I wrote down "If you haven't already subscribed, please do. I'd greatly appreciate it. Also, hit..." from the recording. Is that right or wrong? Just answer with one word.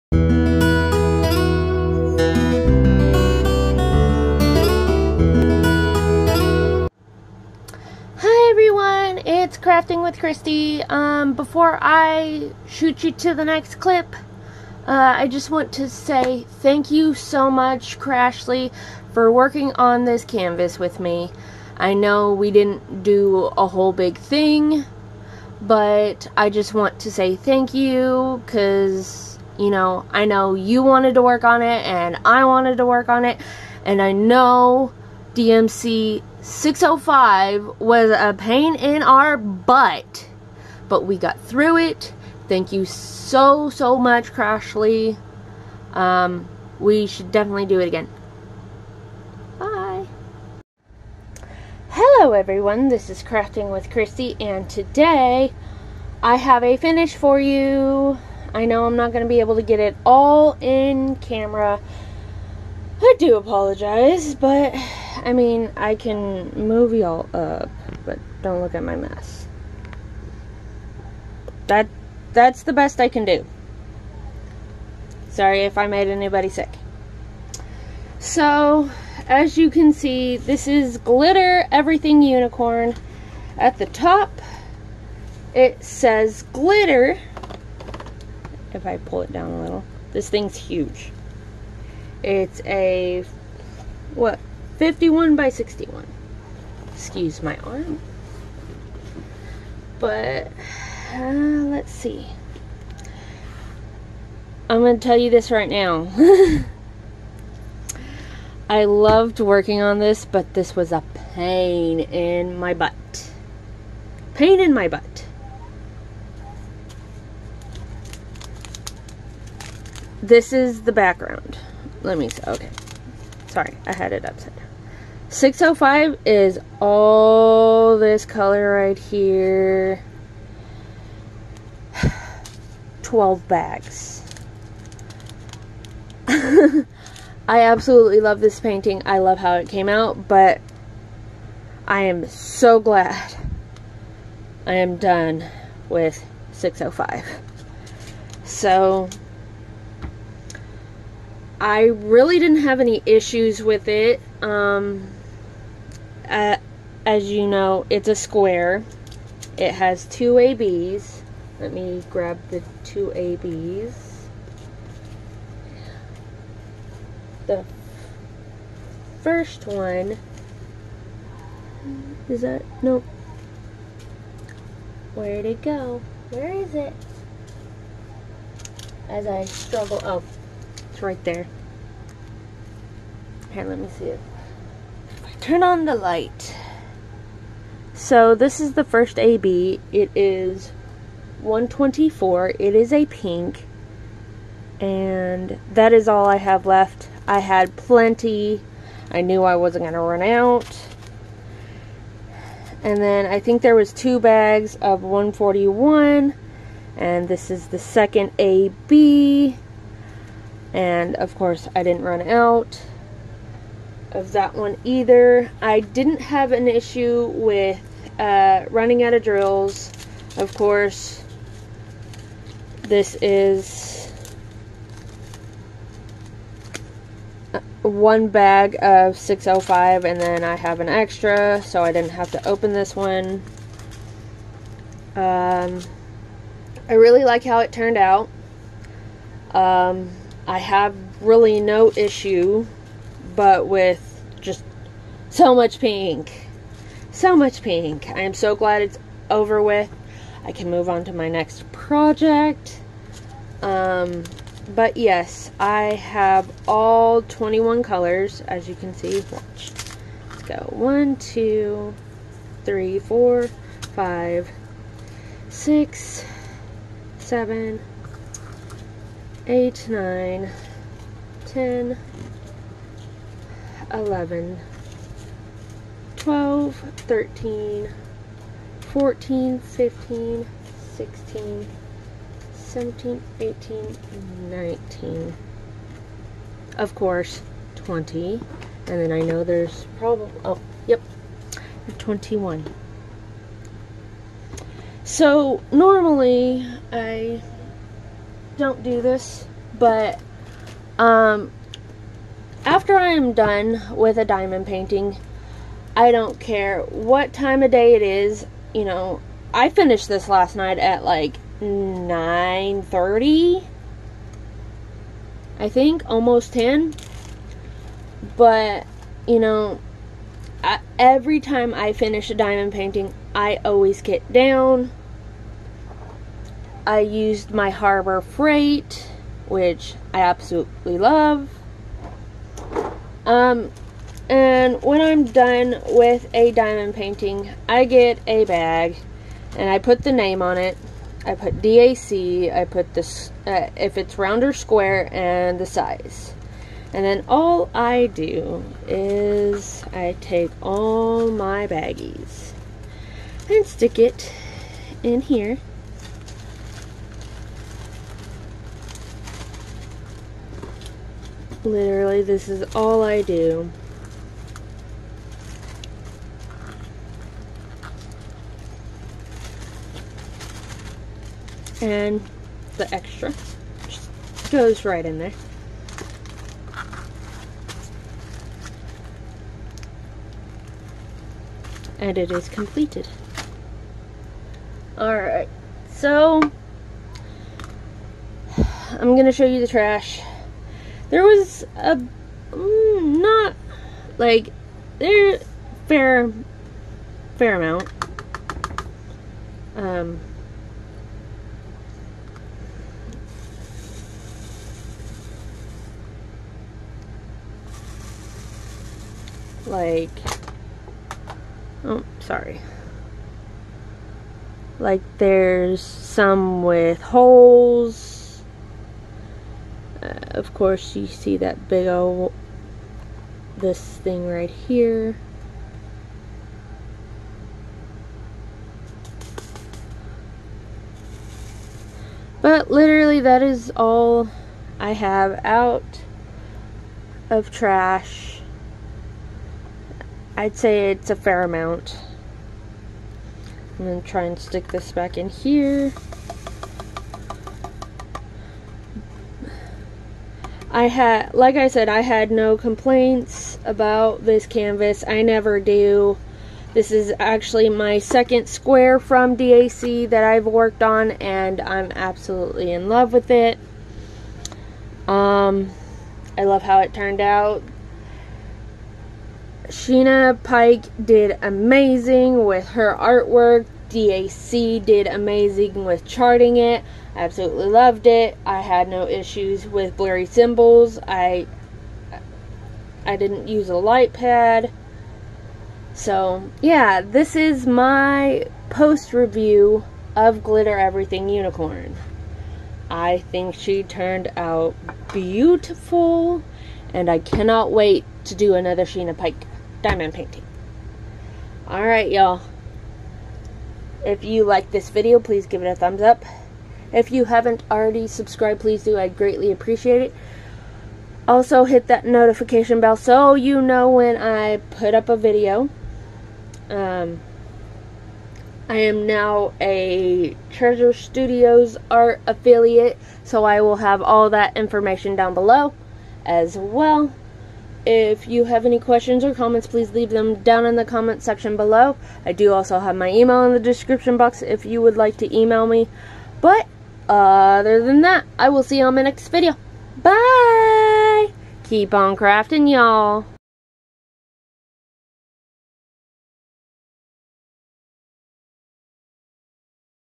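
right.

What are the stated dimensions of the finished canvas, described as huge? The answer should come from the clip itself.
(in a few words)
51 by 61.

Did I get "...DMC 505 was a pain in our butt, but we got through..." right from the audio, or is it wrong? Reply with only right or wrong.
wrong.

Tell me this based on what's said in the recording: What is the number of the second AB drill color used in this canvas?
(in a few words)
141.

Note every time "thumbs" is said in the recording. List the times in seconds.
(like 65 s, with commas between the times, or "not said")
505 s.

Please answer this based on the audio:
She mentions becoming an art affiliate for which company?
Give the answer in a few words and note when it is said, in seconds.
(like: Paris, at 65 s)
Treasure Studios, at 520 s.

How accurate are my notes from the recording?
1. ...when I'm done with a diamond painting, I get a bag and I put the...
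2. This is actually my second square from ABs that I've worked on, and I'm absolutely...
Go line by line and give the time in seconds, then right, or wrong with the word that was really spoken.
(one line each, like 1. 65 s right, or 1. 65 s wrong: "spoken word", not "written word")
1. 334 s right
2. 456 s wrong: "DAC", not "ABs".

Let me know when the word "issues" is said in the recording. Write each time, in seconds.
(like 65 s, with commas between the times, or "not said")
153 s, 216 s, 241 s, 479 s.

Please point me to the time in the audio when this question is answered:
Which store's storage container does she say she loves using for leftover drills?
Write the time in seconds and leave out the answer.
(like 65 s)
327 s.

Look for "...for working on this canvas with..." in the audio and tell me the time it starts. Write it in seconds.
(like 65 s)
19 s.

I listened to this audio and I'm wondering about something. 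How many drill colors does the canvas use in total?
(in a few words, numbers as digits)
21.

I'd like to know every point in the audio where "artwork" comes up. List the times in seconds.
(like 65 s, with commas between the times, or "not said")
472 s.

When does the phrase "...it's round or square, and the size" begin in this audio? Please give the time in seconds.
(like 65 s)
343 s.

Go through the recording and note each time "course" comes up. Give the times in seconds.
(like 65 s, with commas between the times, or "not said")
211 s, 220 s, 420 s.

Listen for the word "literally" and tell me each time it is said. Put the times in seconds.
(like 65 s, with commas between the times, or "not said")
361 s, 432 s.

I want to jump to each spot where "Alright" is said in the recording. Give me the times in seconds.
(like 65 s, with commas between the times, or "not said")
384 s, 501 s.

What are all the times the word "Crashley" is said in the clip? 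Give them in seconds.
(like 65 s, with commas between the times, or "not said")
17 s, 44 s.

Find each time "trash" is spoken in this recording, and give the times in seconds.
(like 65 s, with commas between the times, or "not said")
389 s, 437 s.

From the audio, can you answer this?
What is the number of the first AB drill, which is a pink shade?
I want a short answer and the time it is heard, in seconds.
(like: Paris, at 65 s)
124, at 191 s.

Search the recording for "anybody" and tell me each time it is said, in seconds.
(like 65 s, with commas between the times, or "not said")
76 s.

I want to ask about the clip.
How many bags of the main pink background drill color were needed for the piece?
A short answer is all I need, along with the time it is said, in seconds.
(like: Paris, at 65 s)
12, at 133 s.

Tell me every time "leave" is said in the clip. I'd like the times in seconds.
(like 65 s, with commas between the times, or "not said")
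529 s.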